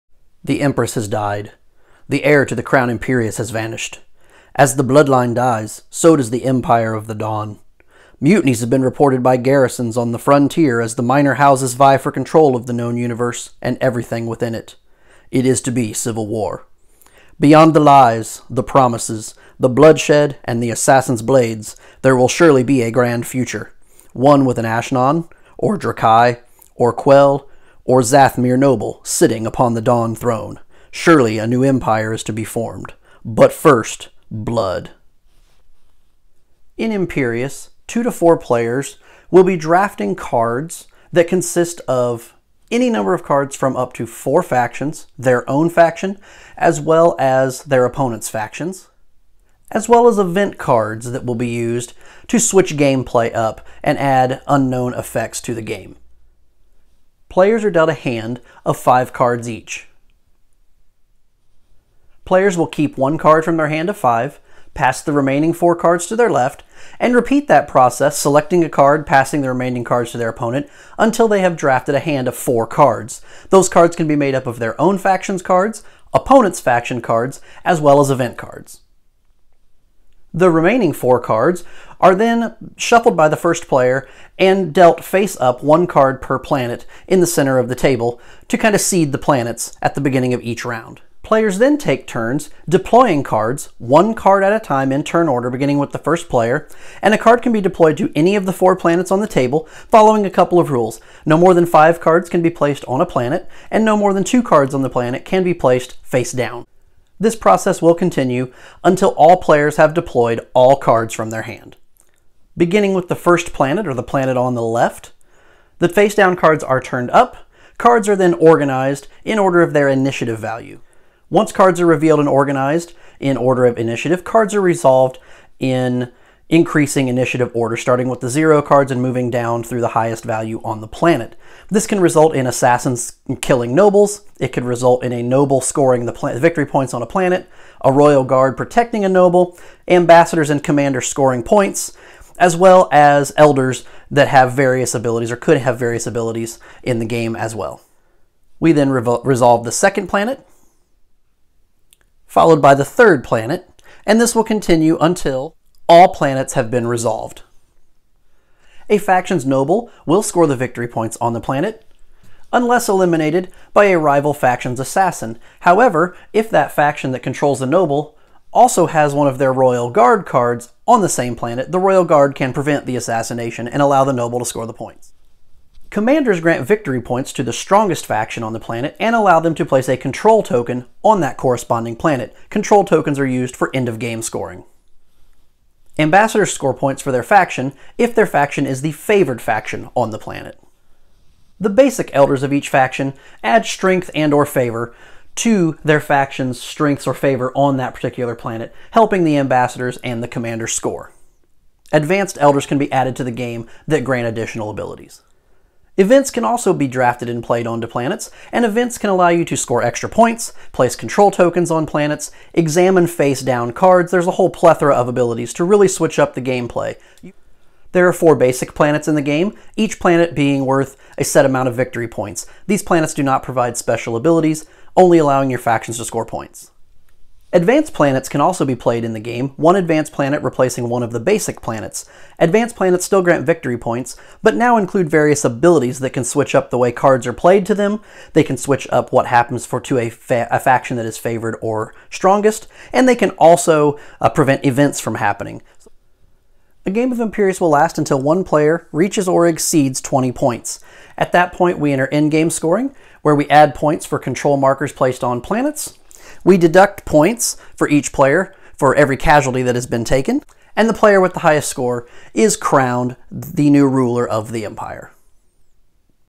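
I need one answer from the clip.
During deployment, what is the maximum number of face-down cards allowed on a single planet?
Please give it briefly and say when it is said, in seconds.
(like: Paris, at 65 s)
2, at 103 s.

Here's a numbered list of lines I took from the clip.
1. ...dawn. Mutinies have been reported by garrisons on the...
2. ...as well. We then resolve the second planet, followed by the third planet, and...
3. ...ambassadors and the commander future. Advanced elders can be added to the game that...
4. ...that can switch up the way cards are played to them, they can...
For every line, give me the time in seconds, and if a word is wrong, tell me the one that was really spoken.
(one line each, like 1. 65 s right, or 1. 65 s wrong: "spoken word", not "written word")
1. 7 s right
2. 147 s right
3. 199 s wrong: "score", not "future"
4. 235 s right.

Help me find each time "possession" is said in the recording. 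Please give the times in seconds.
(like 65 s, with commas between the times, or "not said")
not said.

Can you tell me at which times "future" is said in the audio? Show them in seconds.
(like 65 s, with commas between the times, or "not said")
23 s.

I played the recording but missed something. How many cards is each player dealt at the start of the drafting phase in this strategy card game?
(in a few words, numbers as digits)
5.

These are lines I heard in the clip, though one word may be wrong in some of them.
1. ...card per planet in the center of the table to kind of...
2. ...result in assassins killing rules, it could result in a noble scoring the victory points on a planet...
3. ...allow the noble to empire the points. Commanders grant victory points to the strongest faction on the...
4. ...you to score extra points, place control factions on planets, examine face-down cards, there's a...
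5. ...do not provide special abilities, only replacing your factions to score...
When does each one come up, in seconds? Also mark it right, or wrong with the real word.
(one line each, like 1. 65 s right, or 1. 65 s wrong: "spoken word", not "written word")
1. 85 s right
2. 132 s wrong: "nobles", not "rules"
3. 173 s wrong: "score", not "empire"
4. 209 s wrong: "tokens", not "factions"
5. 223 s wrong: "allowing", not "replacing".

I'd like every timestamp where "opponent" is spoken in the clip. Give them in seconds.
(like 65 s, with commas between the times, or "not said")
47 s, 70 s, 76 s.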